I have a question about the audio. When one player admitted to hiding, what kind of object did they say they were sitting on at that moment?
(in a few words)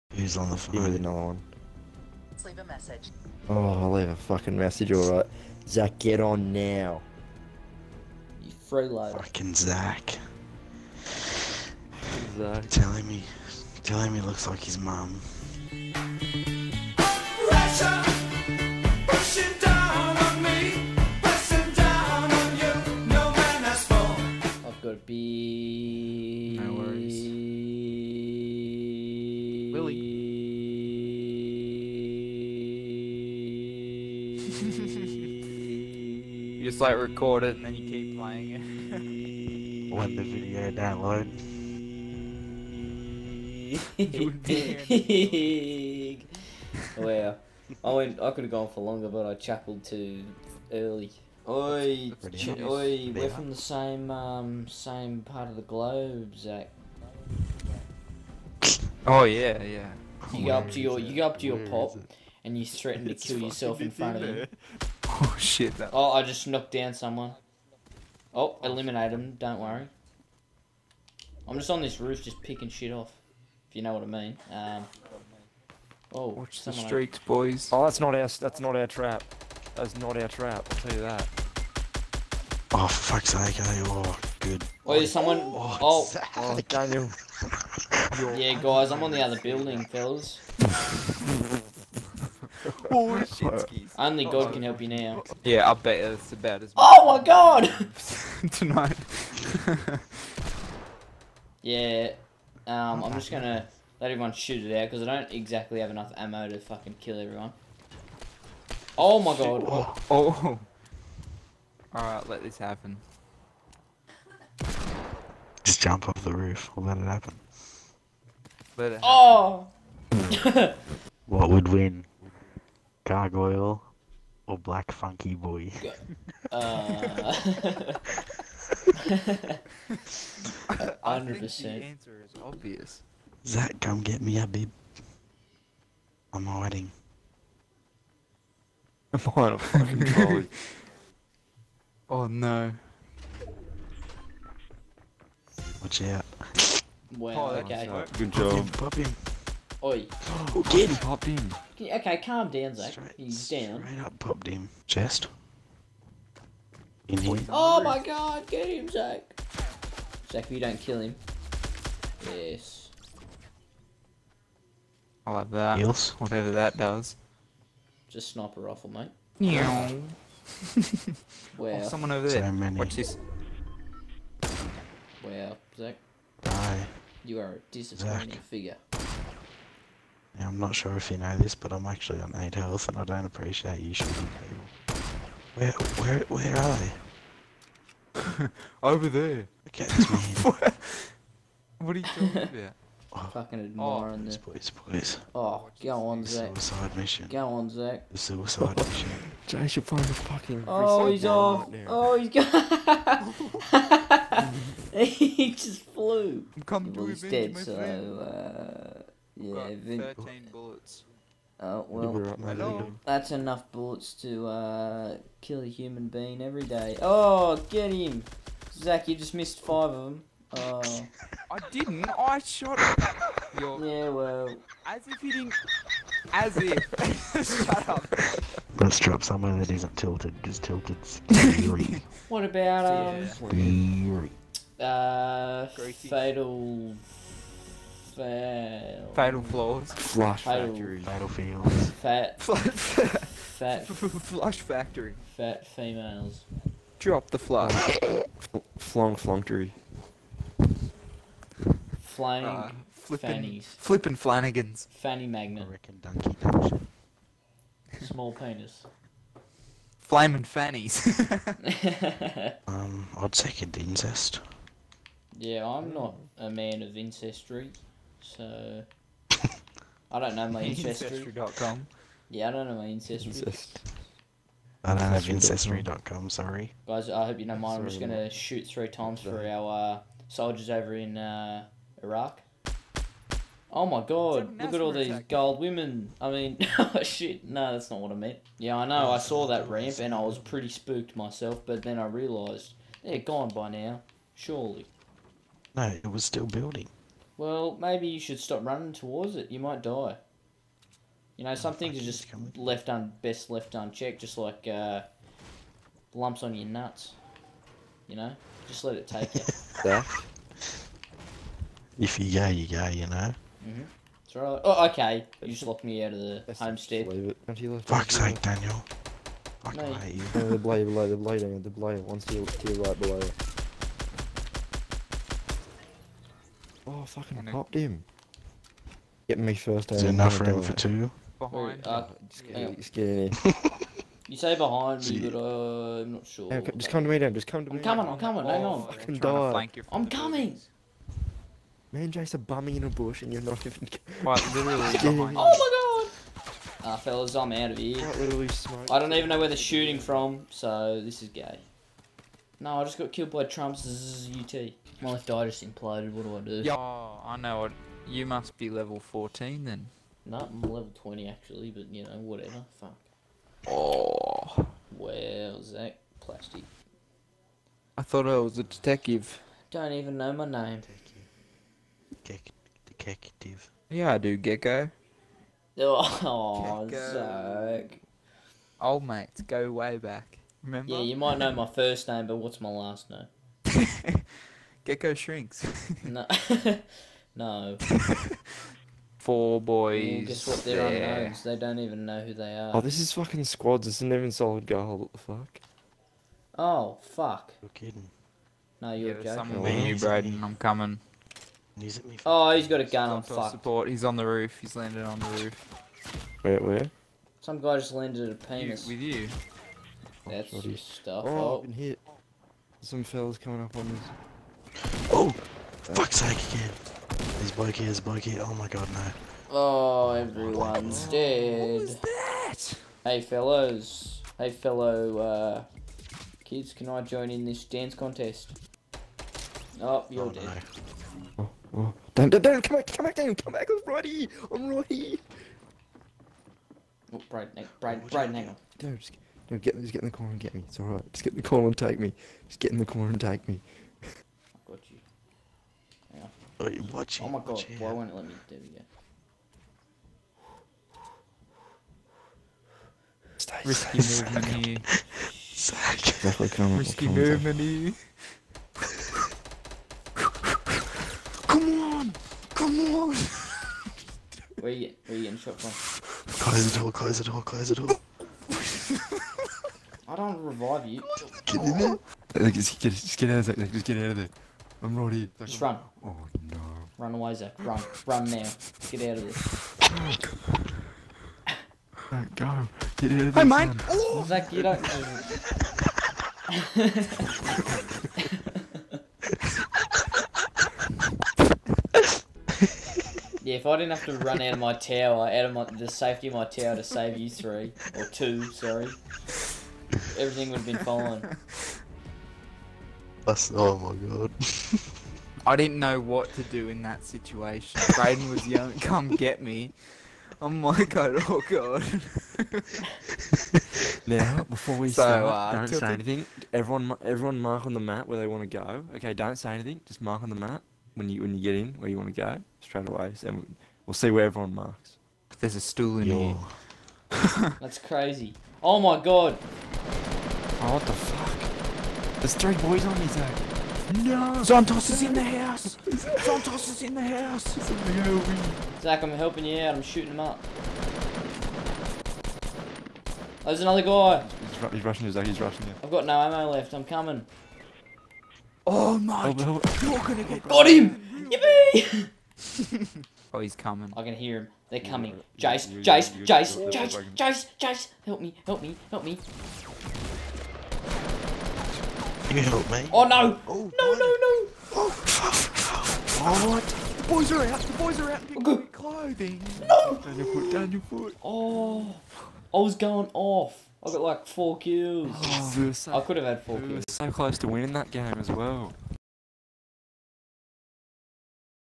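trolley.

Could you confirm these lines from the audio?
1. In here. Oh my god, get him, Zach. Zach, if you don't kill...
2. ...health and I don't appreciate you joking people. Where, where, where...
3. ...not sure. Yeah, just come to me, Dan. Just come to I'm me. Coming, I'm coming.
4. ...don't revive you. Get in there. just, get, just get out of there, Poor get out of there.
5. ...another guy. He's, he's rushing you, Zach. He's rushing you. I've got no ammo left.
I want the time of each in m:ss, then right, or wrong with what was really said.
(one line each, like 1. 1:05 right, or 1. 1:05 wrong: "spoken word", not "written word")
1. 2:37 right
2. 3:02 wrong: "shooting", not "joking"
3. 5:36 right
4. 7:50 wrong: "Just", not "Poor"
5. 9:03 right.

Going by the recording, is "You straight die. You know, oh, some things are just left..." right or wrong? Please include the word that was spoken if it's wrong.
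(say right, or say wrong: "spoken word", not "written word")
wrong: "might", not "straight".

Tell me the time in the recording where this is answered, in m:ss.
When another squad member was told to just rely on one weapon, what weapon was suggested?
2:48.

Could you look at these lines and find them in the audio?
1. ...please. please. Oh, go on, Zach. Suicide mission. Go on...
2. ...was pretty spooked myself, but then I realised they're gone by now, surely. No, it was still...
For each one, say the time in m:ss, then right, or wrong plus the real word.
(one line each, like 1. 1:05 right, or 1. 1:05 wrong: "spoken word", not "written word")
1. 3:14 right
2. 4:50 right.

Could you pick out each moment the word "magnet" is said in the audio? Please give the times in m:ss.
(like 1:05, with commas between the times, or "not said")
4:15.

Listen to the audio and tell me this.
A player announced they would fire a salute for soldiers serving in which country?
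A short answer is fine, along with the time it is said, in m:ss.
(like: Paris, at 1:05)
Iraq, at 4:42.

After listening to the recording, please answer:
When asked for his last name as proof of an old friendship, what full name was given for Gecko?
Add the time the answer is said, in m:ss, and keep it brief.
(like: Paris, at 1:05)
Gecko Shrinks, at 6:24.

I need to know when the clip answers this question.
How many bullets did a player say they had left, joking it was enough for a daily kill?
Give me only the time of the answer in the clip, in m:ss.
3:30.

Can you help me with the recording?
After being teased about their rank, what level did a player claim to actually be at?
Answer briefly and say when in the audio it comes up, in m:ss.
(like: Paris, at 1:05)
20, at 6:00.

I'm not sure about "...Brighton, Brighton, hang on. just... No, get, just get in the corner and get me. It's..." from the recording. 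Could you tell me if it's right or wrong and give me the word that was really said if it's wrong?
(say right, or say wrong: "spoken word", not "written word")
right.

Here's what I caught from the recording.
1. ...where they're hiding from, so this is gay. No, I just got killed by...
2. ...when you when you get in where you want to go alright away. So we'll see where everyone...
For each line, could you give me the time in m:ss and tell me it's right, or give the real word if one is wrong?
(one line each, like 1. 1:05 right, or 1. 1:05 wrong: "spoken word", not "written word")
1. 5:49 wrong: "shooting", not "hiding"
2. 8:40 wrong: "straight", not "alright".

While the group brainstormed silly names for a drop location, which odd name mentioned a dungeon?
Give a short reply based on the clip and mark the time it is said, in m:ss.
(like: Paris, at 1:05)
American Donkey Dungeon, at 4:15.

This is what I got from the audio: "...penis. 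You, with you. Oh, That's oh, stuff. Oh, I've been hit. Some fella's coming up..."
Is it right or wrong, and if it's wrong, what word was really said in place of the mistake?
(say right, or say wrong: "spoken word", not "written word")
right.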